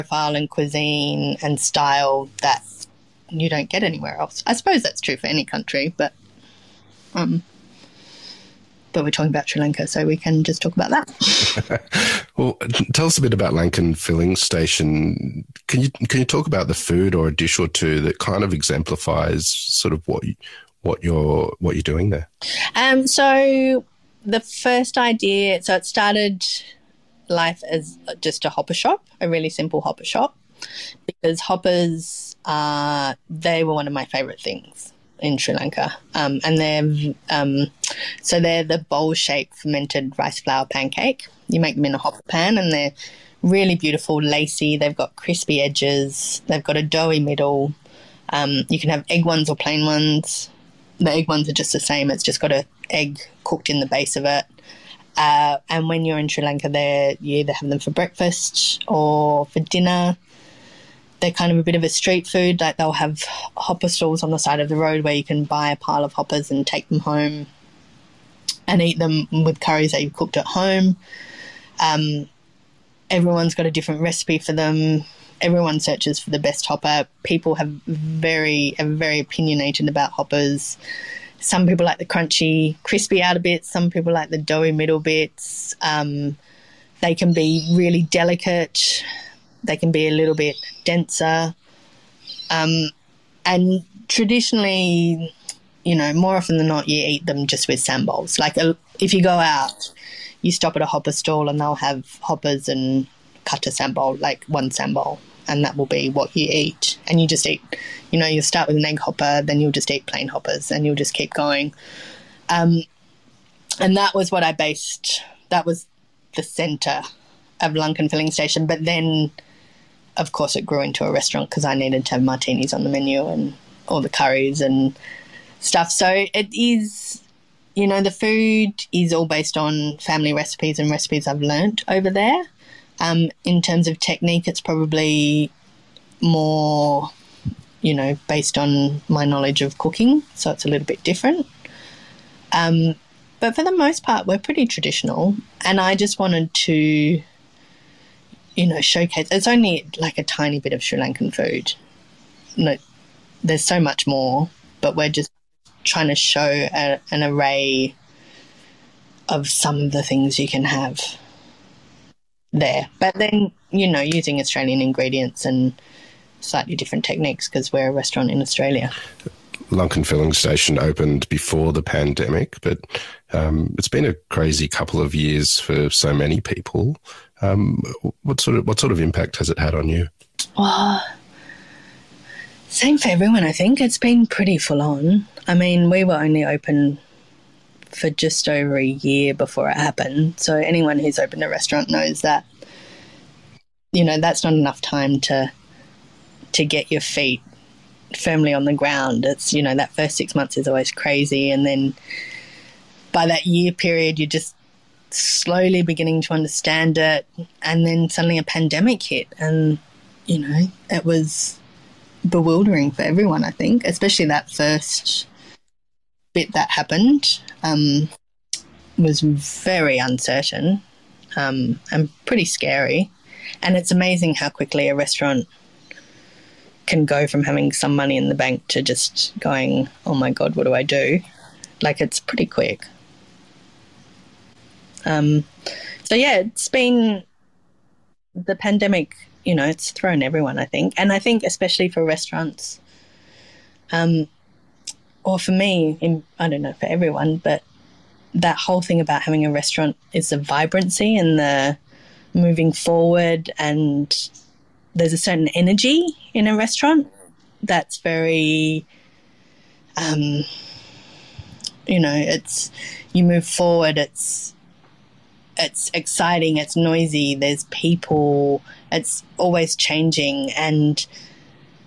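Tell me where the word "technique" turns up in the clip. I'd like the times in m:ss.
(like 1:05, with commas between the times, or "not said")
2:13, 2:47.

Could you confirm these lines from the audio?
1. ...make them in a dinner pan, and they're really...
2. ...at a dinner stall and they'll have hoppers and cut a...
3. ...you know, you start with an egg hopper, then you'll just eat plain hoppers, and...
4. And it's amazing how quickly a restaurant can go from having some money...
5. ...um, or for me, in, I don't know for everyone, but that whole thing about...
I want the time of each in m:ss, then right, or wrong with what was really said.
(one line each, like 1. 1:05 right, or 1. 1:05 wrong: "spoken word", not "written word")
1. 0:41 wrong: "hopper", not "dinner"
2. 1:40 wrong: "hopper", not "dinner"
3. 1:48 right
4. 3:43 right
5. 4:03 right.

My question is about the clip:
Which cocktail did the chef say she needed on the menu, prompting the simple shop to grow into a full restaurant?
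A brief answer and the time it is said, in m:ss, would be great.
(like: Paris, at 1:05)
martinis, at 2:02.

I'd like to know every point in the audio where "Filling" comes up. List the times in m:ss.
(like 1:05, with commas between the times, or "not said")
0:13, 1:58, 2:50.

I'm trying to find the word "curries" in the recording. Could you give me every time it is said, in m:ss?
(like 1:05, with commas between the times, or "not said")
1:09, 2:04.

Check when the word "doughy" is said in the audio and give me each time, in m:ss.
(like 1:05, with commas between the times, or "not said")
0:46, 1:24.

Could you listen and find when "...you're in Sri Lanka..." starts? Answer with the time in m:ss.
0:56.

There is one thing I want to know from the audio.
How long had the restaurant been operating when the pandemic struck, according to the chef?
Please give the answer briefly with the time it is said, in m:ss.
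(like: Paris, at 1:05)
just over a year, at 3:08.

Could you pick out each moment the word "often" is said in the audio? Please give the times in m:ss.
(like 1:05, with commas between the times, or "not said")
1:36.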